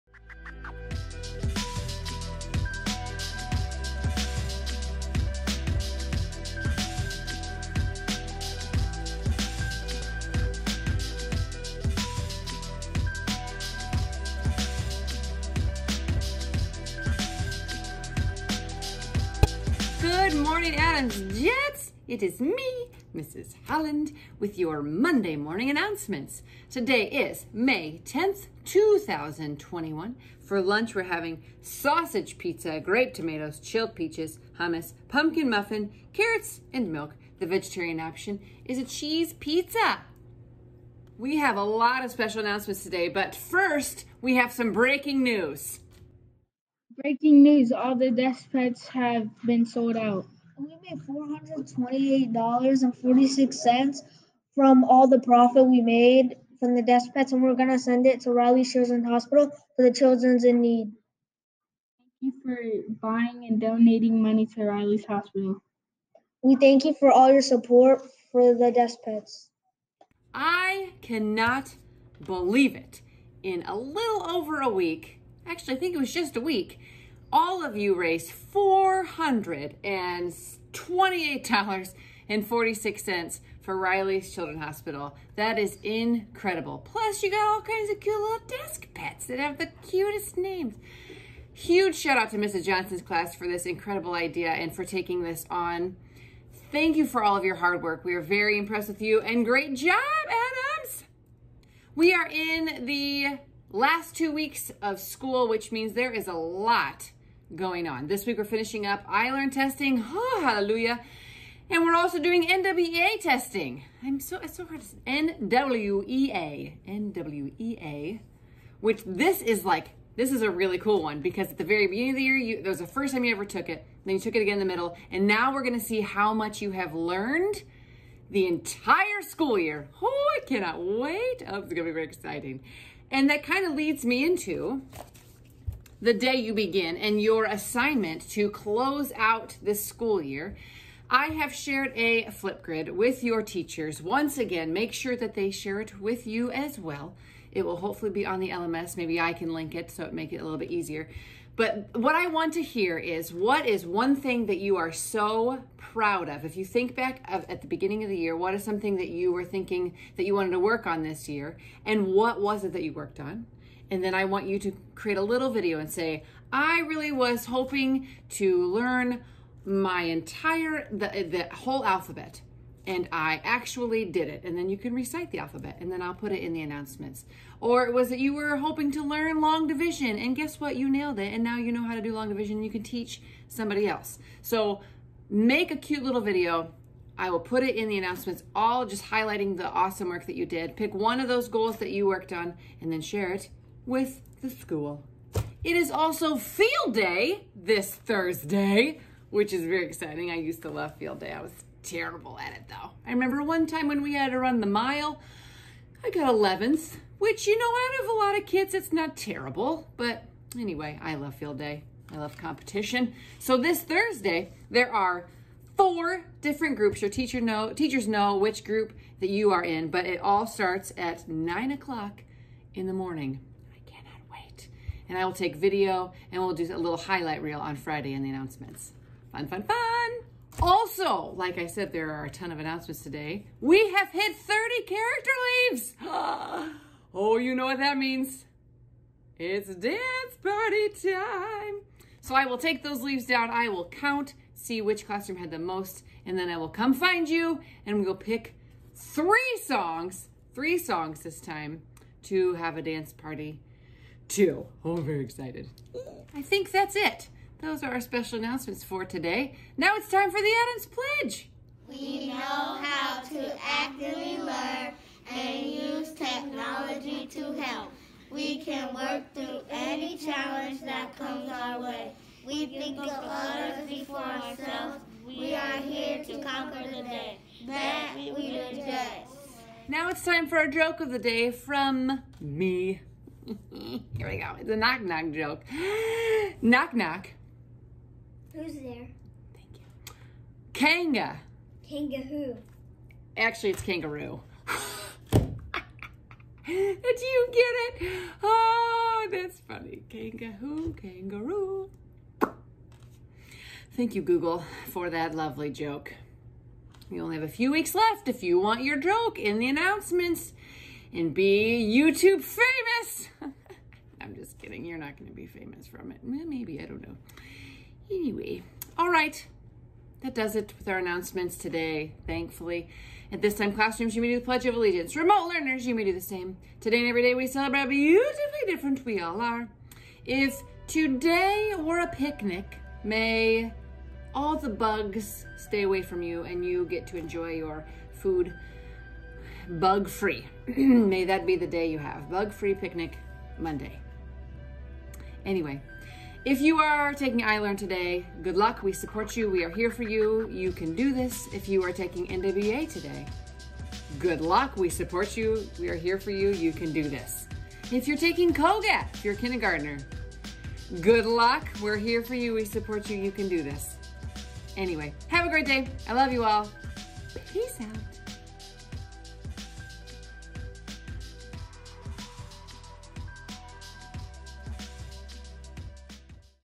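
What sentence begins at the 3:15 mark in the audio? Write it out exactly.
It is also field day this Thursday, which is very exciting.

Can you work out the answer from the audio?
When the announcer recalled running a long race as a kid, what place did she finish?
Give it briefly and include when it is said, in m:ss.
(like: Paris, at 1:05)
11th, at 3:26.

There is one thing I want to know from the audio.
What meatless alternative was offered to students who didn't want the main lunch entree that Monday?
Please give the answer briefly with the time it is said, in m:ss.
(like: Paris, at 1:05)
Cheese pizza, at 0:38.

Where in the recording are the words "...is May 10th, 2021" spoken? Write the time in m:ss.
0:27.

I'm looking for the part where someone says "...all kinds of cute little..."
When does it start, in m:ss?
1:27.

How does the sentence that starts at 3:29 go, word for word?
But anyway, I love field day.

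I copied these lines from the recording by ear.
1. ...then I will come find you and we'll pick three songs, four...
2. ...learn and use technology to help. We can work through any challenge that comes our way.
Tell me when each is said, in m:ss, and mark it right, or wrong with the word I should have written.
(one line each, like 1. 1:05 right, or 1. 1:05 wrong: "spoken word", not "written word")
1. 4:06 wrong: "three", not "four"
2. 4:24 right.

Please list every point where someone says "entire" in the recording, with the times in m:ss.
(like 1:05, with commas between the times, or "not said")
2:08, 2:50.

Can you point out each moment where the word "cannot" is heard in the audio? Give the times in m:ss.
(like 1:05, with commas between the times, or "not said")
1:11, 2:10, 3:43.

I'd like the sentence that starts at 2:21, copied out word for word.
I have shared a Flipgrid with your teachers.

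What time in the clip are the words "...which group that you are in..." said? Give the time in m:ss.
3:38.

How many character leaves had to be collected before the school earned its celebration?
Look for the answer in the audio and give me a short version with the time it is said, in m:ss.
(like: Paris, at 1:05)
30, at 3:54.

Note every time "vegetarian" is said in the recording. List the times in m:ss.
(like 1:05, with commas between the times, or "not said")
0:37.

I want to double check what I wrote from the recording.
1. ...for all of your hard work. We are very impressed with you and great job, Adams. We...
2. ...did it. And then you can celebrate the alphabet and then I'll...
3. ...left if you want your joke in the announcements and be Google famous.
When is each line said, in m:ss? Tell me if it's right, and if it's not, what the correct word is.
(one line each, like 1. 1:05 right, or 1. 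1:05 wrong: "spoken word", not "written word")
1. 1:37 right
2. 2:54 wrong: "recite", not "celebrate"
3. 5:07 wrong: "YouTube", not "Google".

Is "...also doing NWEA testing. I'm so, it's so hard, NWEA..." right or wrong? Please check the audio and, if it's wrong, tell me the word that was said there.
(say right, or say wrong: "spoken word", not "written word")
right.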